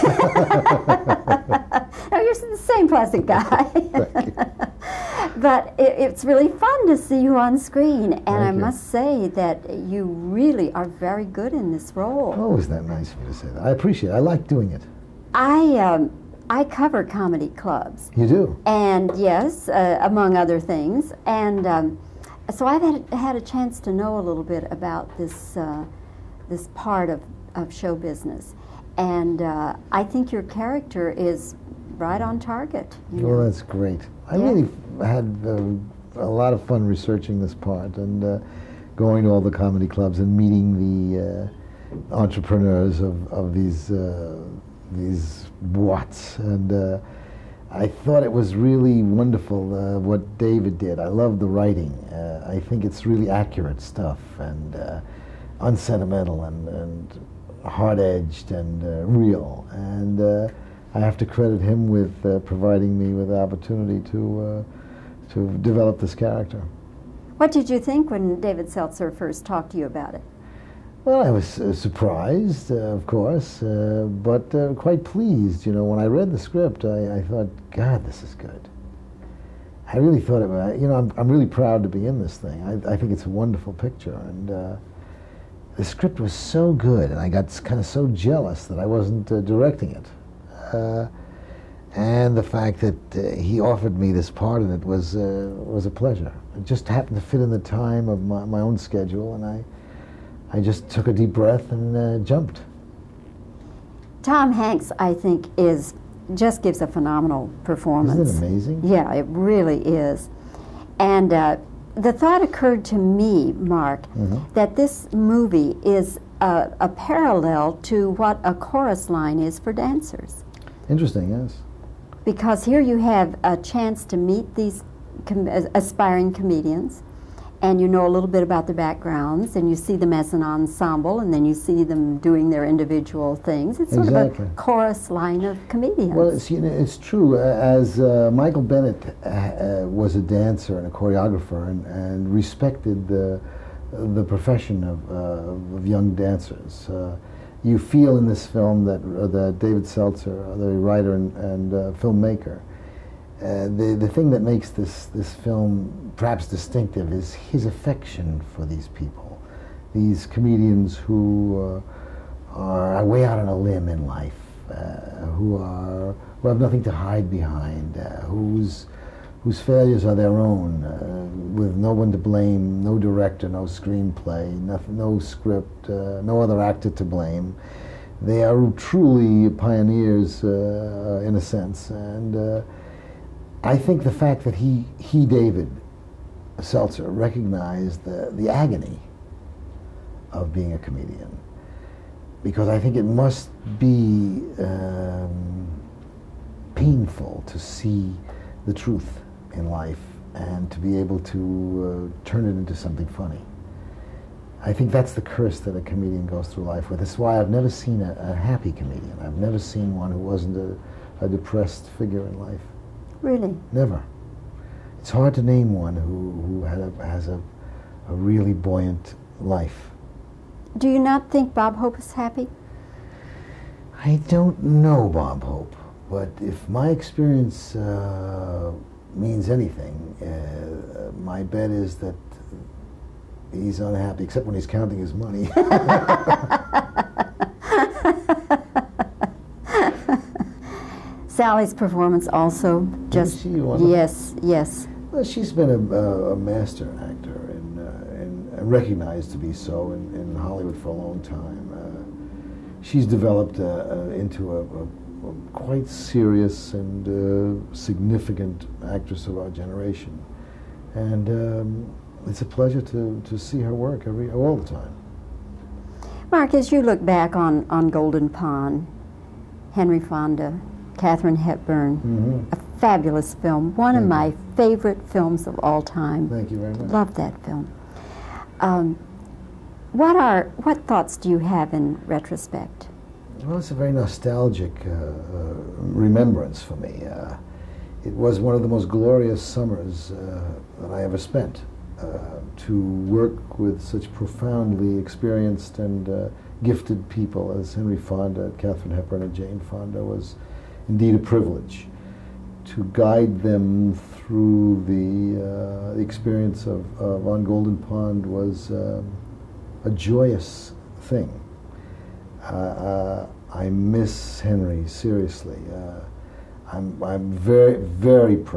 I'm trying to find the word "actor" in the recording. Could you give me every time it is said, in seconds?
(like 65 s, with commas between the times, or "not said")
176 s, 247 s.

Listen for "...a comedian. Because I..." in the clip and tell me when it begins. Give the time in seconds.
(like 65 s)
190 s.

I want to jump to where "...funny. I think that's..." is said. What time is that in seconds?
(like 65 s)
203 s.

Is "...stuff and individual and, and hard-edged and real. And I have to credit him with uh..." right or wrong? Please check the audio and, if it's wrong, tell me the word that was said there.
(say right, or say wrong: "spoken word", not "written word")
wrong: "unsentimental", not "individual".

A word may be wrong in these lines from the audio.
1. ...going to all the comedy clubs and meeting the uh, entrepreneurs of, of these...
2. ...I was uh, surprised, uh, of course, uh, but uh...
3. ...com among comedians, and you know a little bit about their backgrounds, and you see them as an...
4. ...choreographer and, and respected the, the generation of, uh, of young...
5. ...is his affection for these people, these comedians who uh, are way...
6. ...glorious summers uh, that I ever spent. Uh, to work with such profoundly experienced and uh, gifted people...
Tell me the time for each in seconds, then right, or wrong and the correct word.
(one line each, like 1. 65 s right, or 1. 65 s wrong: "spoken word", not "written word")
1. 38 s right
2. 71 s right
3. 125 s wrong: "aspiring", not "among"
4. 140 s wrong: "profession", not "generation"
5. 157 s right
6. 288 s right.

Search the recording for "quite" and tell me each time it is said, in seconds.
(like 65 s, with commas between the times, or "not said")
74 s, 255 s.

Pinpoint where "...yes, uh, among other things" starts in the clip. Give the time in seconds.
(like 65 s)
19 s.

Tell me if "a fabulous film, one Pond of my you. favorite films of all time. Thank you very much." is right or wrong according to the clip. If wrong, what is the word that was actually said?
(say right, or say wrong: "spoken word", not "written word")
wrong: "Thank", not "Pond".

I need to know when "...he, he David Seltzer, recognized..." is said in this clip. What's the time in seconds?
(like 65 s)
184 s.